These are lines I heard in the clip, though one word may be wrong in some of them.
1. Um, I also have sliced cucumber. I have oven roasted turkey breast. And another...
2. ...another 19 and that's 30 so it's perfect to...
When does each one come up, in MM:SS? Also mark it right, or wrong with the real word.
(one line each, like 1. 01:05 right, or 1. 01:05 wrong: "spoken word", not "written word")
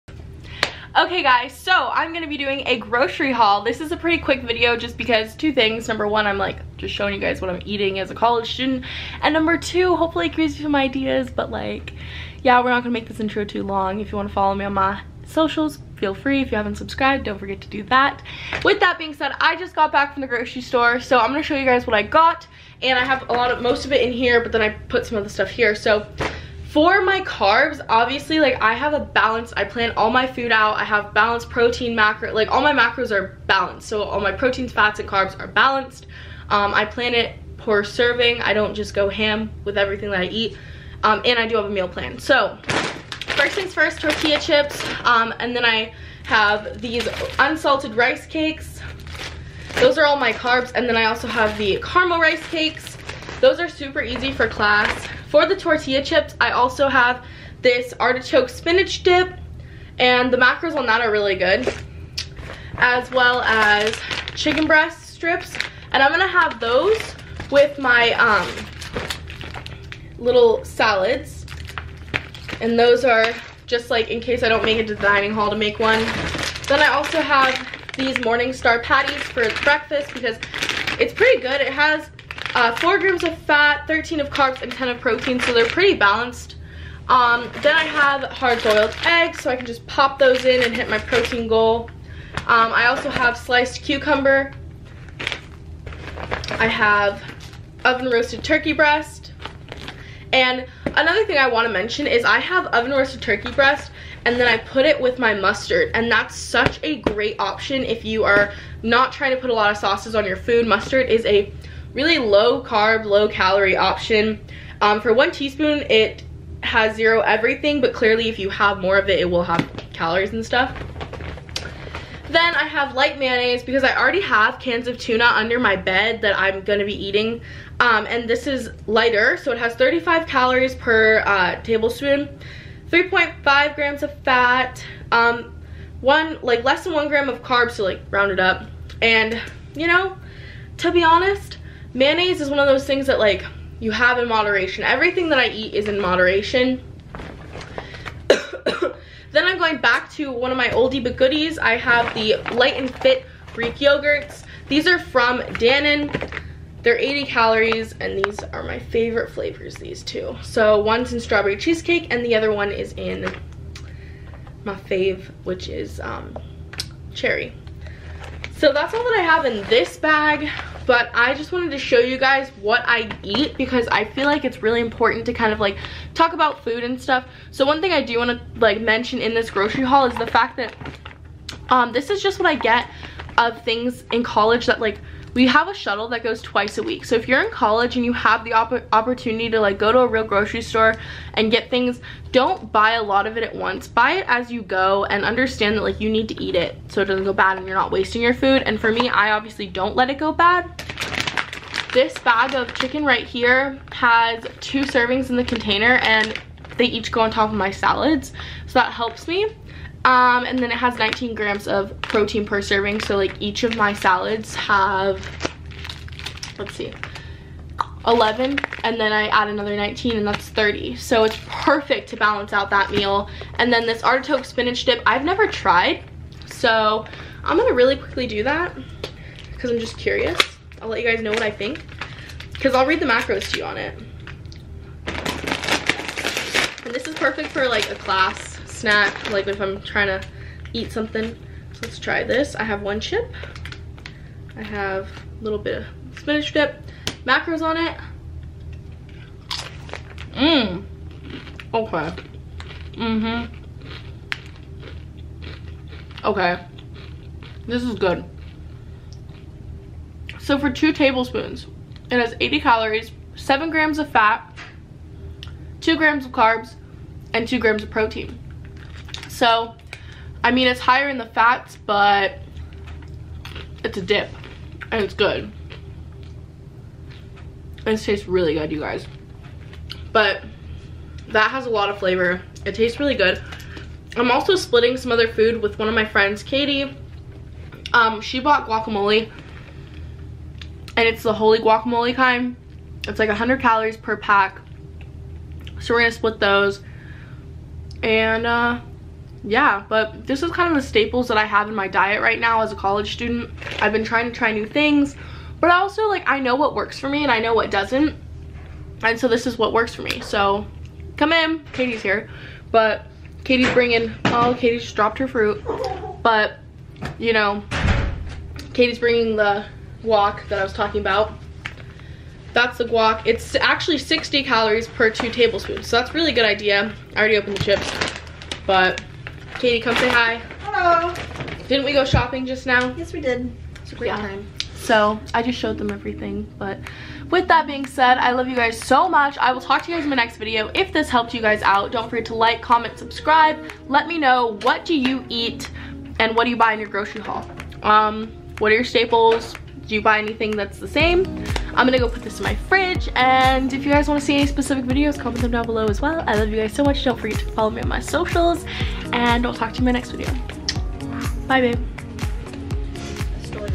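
1. 01:32 right
2. 03:39 right.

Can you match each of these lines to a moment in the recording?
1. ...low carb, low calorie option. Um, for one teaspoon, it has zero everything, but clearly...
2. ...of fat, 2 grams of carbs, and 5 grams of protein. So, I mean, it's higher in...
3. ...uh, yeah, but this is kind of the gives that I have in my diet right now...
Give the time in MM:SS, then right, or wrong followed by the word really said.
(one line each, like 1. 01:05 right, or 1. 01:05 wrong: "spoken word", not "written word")
1. 01:52 right
2. 04:23 wrong: "2", not "5"
3. 04:58 wrong: "staples", not "gives".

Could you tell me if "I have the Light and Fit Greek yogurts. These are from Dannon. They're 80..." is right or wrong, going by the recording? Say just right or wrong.
right.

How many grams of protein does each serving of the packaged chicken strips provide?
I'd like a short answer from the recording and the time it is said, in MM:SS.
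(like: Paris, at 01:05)
19, at 03:30.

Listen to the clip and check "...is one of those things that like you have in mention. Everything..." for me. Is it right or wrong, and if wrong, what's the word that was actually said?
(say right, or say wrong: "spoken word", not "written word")
wrong: "moderation", not "mention".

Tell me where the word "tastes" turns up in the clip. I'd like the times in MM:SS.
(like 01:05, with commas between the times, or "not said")
04:37, 04:42.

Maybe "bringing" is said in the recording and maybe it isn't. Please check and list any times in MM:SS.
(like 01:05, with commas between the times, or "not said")
05:13, 05:18.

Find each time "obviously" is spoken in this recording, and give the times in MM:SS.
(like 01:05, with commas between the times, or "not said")
00:27, 03:19.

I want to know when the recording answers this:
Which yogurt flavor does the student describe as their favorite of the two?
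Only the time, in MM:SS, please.
02:47.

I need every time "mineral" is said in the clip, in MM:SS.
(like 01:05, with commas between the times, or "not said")
not said.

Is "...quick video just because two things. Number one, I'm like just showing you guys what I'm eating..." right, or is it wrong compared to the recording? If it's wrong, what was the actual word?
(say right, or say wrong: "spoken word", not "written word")
right.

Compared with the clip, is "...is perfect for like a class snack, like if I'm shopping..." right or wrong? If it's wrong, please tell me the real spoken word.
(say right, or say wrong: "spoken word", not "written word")
wrong: "trying", not "shopping".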